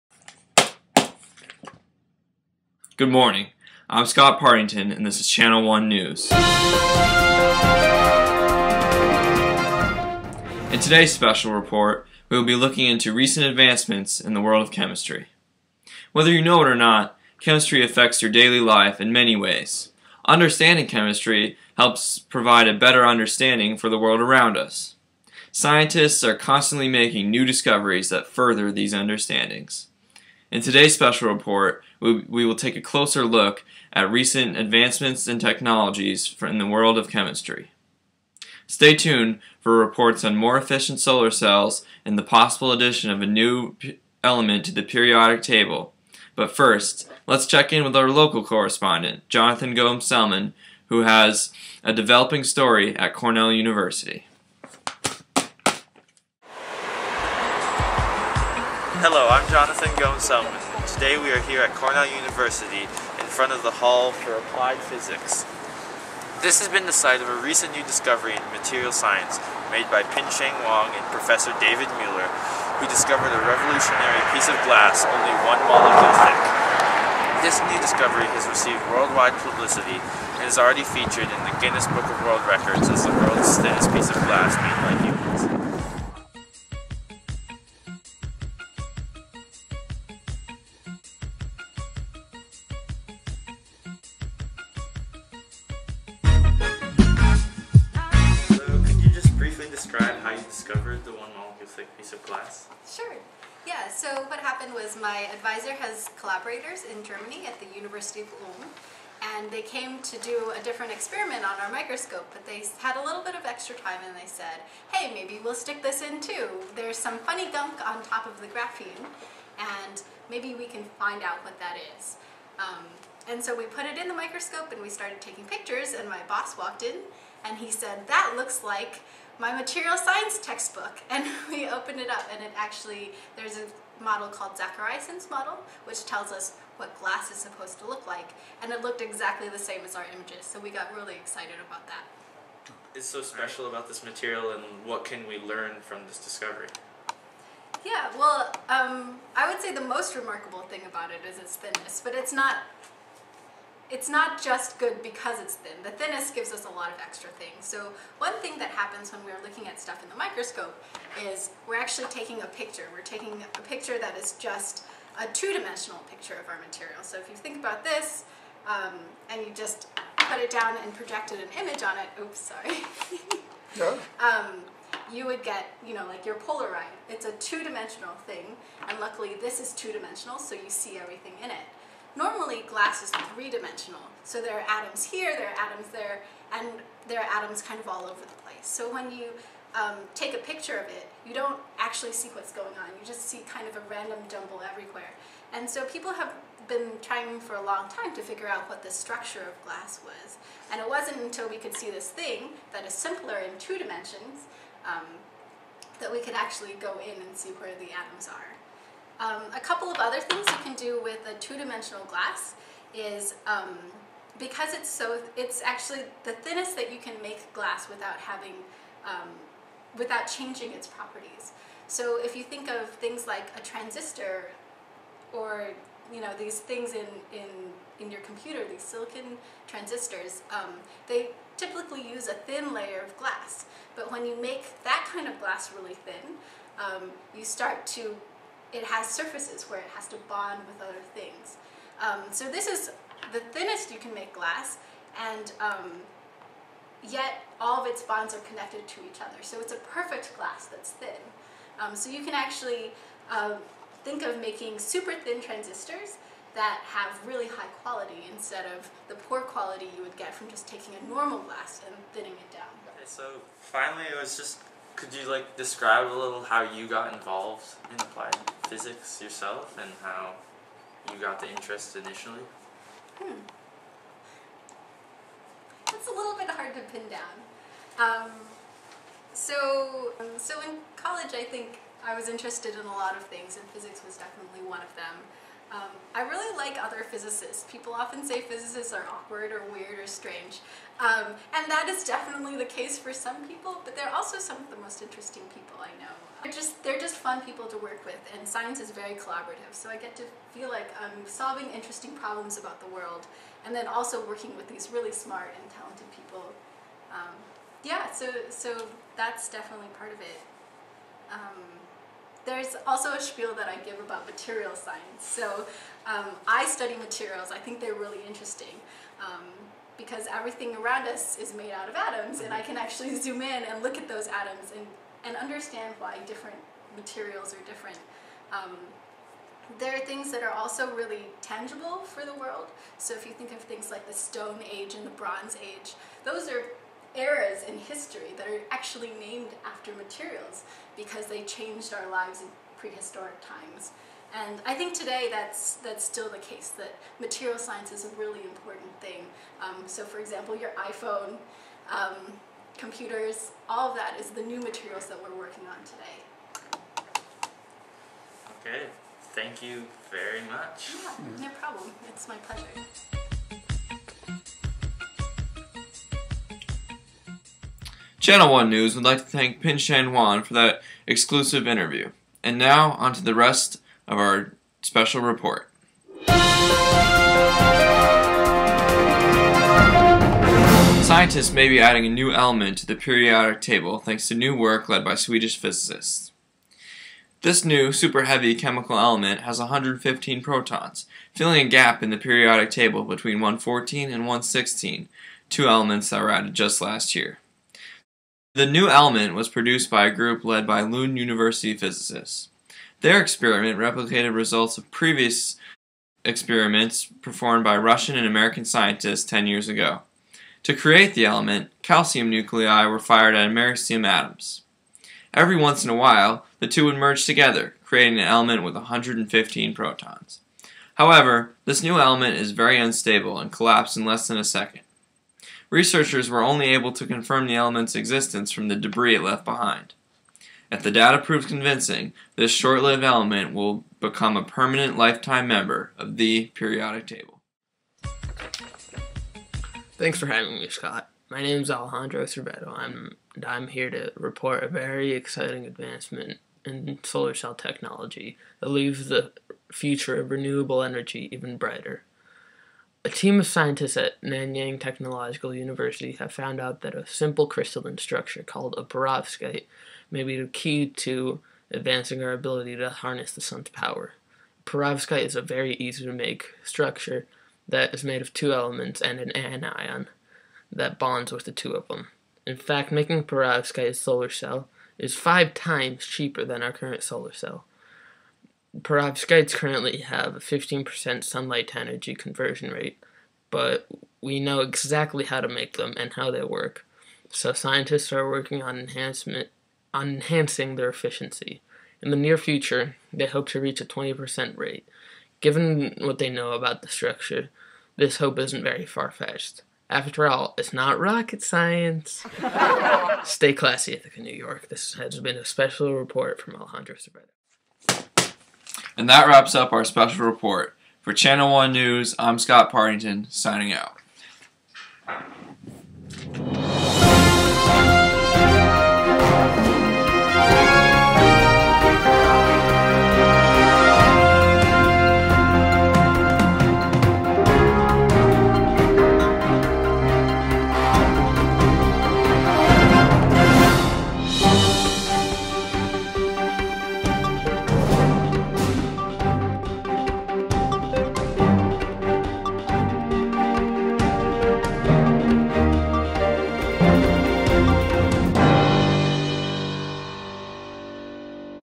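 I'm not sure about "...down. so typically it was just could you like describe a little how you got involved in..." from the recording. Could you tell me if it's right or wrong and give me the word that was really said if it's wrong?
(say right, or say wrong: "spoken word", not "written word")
wrong: "finally", not "typically".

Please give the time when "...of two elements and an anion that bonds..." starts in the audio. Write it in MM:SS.
07:48.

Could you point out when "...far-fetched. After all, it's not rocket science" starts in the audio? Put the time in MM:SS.
08:18.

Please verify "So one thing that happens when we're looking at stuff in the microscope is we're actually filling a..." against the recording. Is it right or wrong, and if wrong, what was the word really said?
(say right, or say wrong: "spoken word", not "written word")
wrong: "taking", not "filling".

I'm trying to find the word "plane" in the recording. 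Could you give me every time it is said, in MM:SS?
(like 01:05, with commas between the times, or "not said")
not said.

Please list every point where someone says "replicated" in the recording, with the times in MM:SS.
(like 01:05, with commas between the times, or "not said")
06:43.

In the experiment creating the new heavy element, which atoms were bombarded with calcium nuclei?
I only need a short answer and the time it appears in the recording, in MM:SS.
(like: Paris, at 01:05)
americium, at 06:53.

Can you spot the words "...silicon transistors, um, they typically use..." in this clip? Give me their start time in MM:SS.
03:48.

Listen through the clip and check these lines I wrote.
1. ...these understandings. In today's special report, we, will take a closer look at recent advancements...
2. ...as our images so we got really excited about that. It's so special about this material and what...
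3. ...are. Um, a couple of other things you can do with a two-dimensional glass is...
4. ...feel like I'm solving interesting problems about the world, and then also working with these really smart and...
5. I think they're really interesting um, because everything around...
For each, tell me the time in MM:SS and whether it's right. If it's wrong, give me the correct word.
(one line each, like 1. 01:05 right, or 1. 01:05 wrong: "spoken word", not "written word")
1. 00:28 right
2. 02:19 right
3. 03:28 right
4. 05:00 right
5. 05:17 right.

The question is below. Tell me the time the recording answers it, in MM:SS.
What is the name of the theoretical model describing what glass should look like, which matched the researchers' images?
02:14.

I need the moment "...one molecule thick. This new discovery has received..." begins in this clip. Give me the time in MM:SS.
01:15.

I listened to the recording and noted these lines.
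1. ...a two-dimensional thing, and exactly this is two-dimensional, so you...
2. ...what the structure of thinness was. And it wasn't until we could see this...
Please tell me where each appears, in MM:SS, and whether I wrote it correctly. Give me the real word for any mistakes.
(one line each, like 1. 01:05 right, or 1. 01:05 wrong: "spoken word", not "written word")
1. 02:57 wrong: "luckily", not "exactly"
2. 03:18 wrong: "glass", not "thinness".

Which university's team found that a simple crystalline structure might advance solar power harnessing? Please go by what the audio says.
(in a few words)
Nanyang Technological University.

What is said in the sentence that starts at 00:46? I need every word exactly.
But first, let's check in with our local correspondent, Jonathan Gomes Selman, who has a developing story at Cornell University.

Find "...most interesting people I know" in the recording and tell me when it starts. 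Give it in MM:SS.
04:54.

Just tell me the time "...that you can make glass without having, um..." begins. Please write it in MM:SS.
03:36.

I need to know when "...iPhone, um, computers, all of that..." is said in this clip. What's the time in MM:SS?
05:50.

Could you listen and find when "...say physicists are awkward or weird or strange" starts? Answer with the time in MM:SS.
04:48.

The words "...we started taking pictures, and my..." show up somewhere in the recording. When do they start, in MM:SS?
02:04.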